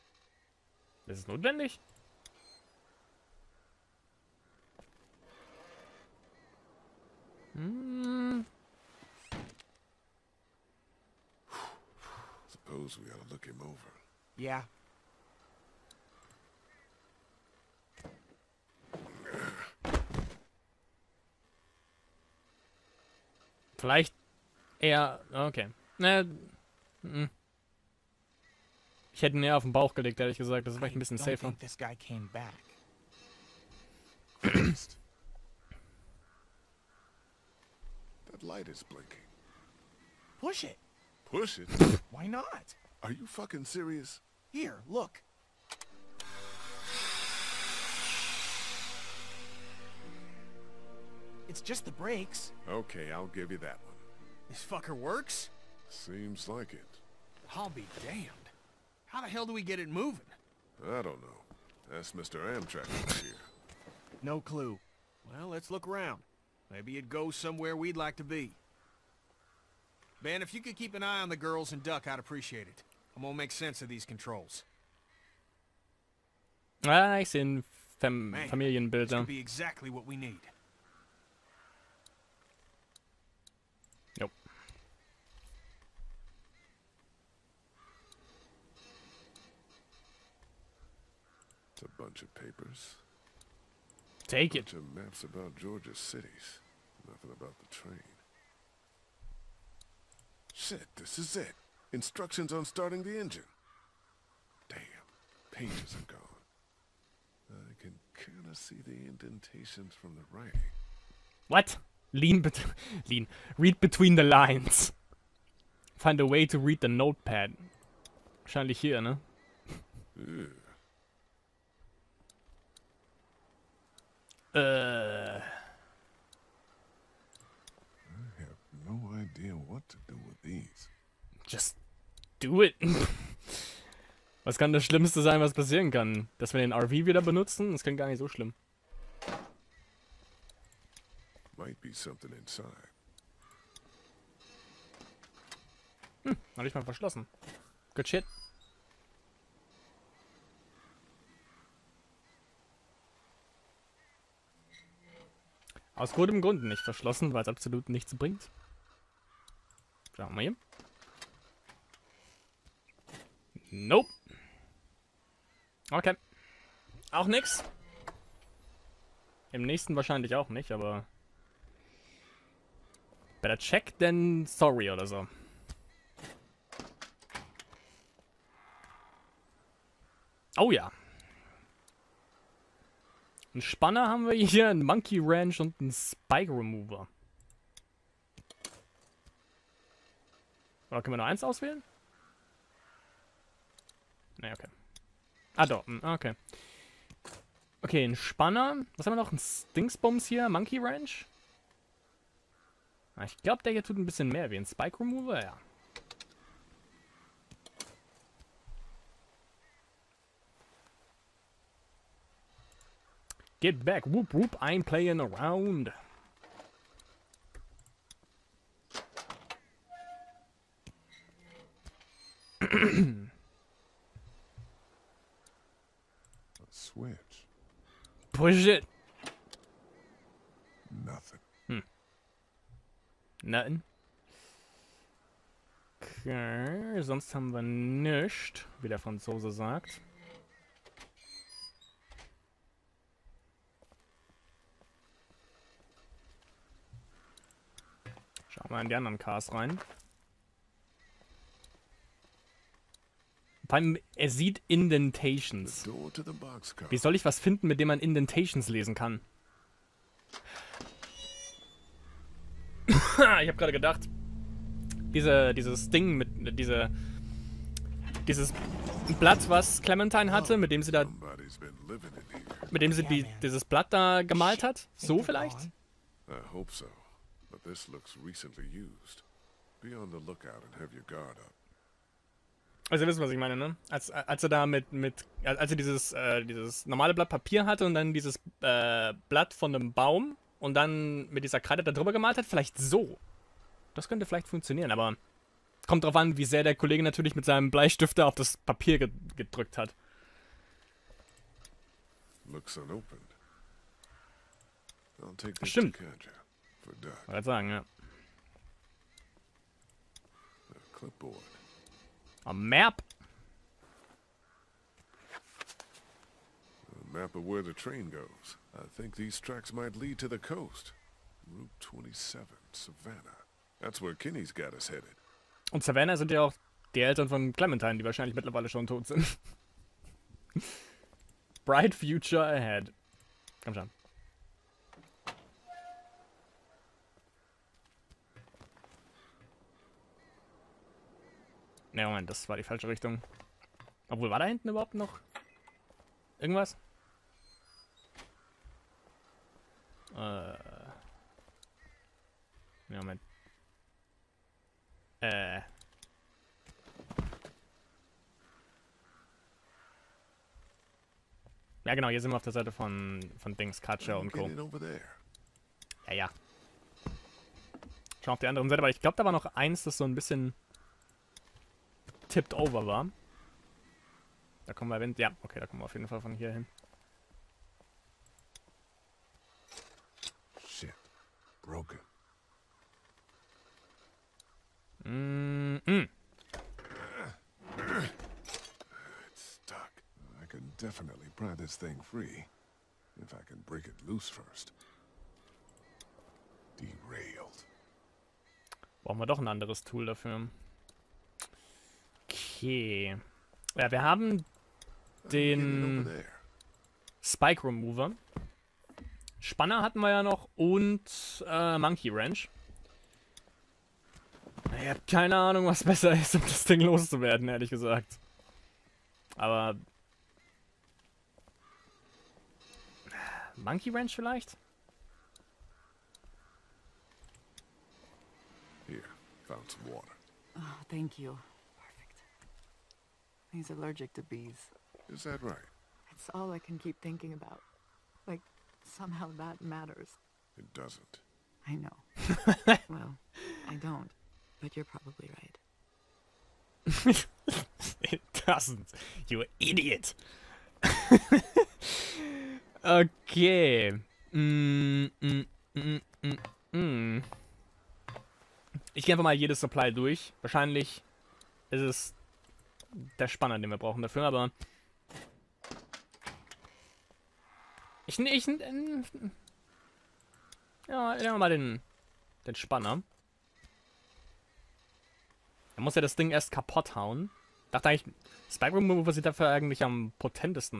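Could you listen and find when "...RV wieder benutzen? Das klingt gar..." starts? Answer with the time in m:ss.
2:16.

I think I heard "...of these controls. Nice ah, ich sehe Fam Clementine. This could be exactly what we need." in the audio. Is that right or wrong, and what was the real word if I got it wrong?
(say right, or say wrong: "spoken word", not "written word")
wrong: "Familienbilder", not "Clementine".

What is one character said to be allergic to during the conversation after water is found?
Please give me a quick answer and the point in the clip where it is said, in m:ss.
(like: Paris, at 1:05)
bees, at 7:14.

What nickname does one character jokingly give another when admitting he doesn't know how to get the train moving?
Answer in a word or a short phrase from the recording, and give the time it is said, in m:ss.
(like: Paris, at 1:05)
Mr. Amtrak, at 1:02.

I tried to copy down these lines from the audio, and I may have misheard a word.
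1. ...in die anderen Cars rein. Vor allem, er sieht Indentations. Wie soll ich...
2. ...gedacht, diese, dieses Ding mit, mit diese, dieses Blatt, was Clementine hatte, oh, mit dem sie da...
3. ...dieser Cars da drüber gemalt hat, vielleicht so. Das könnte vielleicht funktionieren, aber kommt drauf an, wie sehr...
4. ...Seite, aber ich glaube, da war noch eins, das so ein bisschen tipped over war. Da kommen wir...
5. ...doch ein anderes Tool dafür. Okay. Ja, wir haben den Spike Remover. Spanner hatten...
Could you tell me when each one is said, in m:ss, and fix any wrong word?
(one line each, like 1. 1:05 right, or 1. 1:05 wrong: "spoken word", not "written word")
1. 4:08 right
2. 4:23 right
3. 4:51 wrong: "Kreide", not "Cars"
4. 6:08 right
5. 6:39 right.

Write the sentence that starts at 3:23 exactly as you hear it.
Ah, ich glaube, der hier tut ein bisschen mehr wie ein Spike Remover.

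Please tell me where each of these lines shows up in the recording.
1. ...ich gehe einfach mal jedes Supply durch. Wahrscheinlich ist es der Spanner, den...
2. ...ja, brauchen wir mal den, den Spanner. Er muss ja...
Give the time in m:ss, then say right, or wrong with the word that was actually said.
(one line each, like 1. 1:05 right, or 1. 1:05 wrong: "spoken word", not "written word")
1. 7:38 right
2. 7:50 wrong: "nehmen", not "brauchen".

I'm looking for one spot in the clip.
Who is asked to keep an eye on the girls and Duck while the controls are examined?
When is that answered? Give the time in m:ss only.
1:10.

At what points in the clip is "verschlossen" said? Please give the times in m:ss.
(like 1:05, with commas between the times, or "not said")
2:26, 2:36.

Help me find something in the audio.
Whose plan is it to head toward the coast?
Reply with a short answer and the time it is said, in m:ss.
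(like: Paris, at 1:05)
Kenny, at 5:24.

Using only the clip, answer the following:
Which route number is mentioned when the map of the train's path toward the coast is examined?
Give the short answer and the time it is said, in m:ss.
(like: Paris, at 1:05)
27, at 5:21.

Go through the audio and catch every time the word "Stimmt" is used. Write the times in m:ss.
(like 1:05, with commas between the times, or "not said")
5:05.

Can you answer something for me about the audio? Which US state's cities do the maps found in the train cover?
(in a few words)
Georgia.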